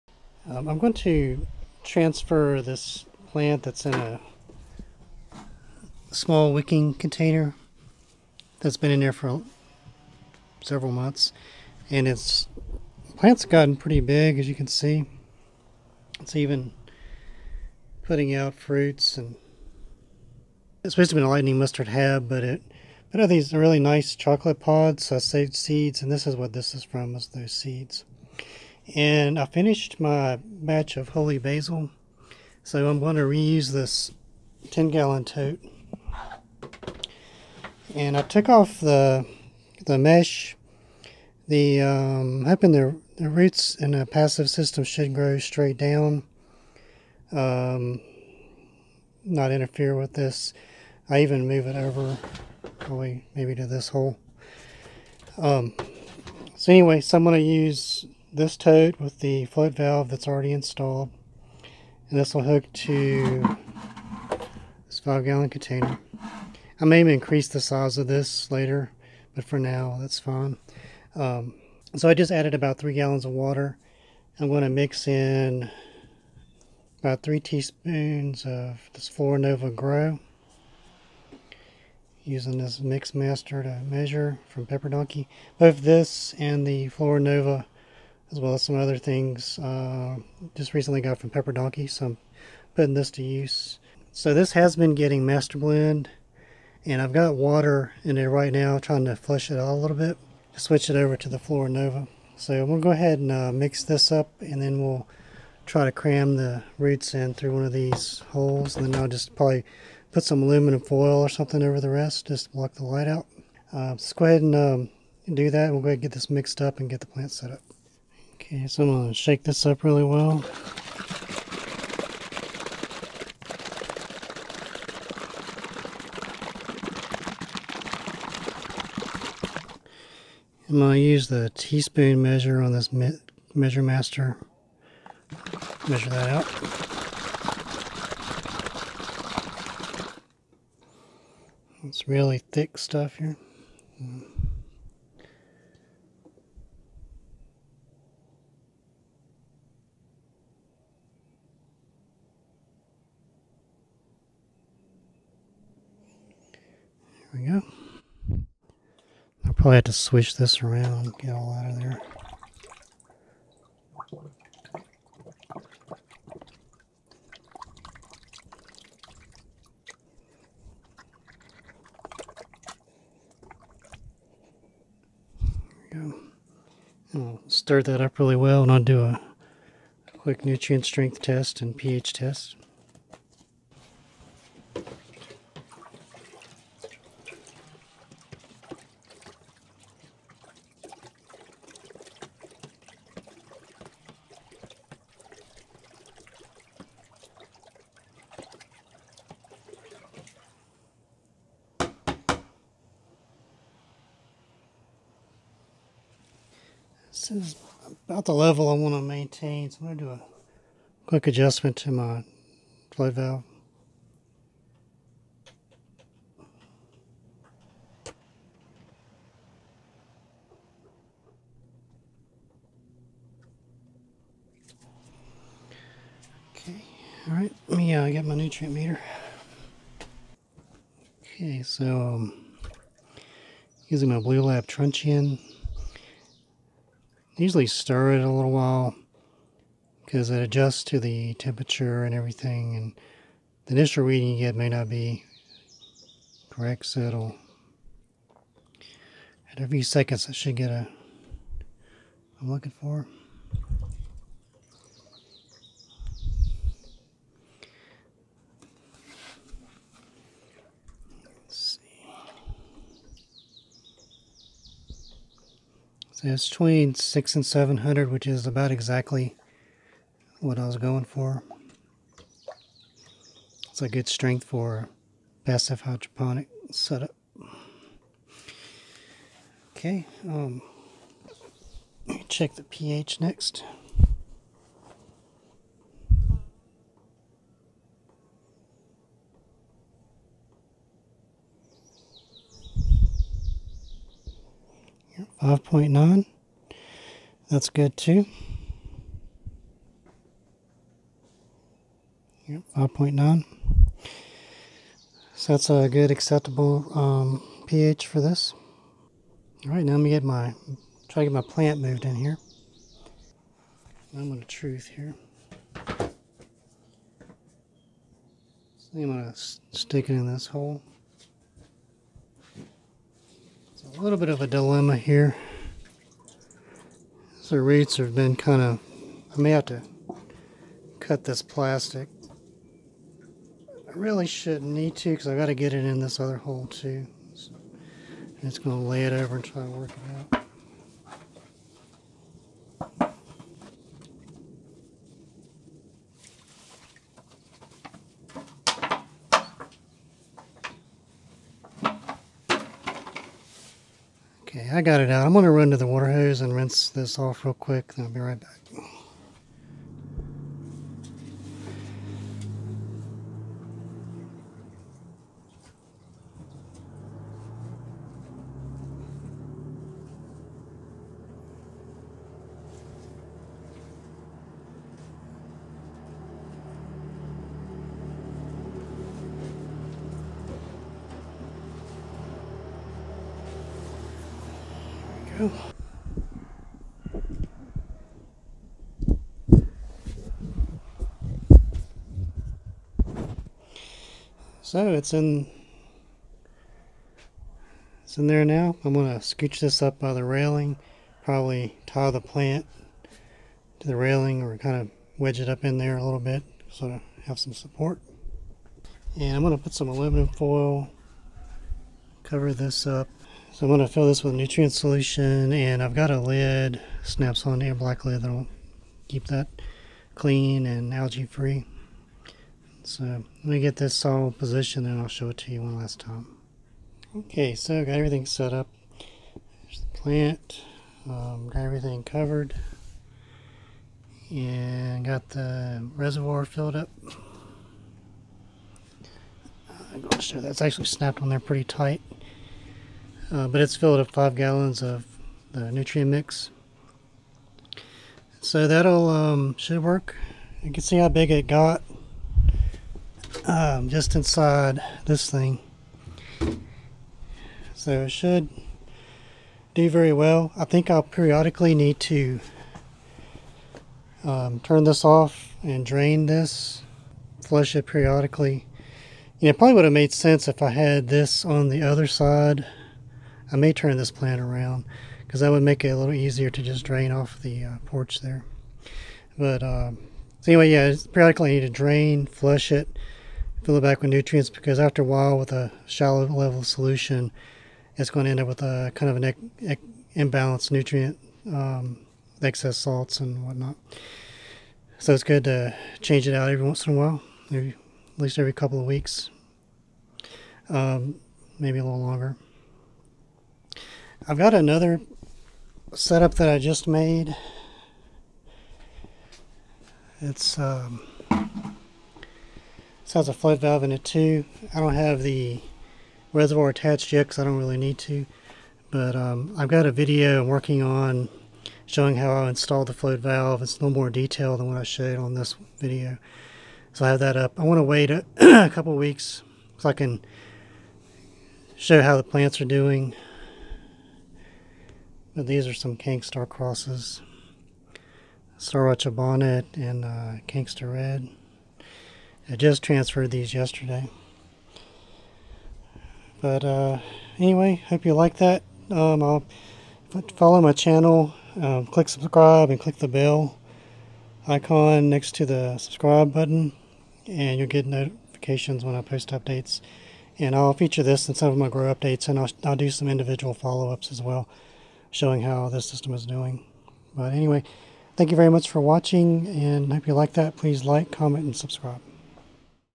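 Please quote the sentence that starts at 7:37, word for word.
So it should do very well.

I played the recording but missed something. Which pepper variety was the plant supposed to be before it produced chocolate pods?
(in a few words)
Lightning mustard hab.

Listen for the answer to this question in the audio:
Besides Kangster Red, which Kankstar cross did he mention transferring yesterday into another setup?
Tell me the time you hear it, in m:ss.
8:58.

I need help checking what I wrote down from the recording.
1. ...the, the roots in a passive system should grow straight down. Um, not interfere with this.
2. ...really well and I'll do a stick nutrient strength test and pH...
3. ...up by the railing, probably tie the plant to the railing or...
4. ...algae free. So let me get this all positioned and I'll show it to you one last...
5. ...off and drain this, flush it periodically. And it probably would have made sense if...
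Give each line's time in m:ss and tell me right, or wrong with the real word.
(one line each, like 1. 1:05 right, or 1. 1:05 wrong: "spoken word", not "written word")
1. 0:42 right
2. 2:58 wrong: "quick", not "stick"
3. 6:39 right
4. 7:00 right
5. 7:45 right.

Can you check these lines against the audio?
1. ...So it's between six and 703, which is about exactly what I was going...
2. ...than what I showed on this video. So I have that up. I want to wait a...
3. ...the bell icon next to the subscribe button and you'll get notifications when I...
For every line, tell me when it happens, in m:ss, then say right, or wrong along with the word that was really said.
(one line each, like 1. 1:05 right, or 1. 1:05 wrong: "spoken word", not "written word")
1. 4:26 wrong: "700", not "703"
2. 8:44 right
3. 9:12 right.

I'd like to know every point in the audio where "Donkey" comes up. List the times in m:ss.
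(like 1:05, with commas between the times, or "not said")
1:24, 1:31.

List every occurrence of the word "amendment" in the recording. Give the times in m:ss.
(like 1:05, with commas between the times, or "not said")
not said.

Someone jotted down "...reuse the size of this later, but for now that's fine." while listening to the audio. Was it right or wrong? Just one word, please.
wrong.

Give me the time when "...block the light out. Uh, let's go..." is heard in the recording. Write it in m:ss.
1:52.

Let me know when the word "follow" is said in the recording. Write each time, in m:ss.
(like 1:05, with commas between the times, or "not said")
9:10, 9:23.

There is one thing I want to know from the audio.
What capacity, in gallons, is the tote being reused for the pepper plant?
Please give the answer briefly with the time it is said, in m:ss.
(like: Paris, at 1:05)
10 gallon, at 0:34.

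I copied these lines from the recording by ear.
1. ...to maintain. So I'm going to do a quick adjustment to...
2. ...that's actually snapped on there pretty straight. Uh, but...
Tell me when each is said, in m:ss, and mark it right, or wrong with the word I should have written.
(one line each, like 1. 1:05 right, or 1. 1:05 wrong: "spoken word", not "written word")
1. 3:28 right
2. 7:20 wrong: "tight", not "straight".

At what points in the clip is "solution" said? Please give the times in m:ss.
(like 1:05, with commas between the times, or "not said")
6:54, 8:06.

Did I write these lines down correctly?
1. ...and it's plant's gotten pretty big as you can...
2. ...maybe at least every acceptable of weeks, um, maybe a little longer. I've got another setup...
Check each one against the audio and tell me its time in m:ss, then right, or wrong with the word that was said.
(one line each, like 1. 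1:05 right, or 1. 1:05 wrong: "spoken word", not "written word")
1. 0:11 right
2. 8:17 wrong: "couple", not "acceptable".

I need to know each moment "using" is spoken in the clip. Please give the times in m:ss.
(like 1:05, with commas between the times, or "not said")
1:22, 3:53.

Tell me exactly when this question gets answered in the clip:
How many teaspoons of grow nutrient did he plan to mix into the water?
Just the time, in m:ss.
1:17.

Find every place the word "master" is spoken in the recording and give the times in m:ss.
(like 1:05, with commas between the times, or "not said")
1:23, 1:35, 2:13.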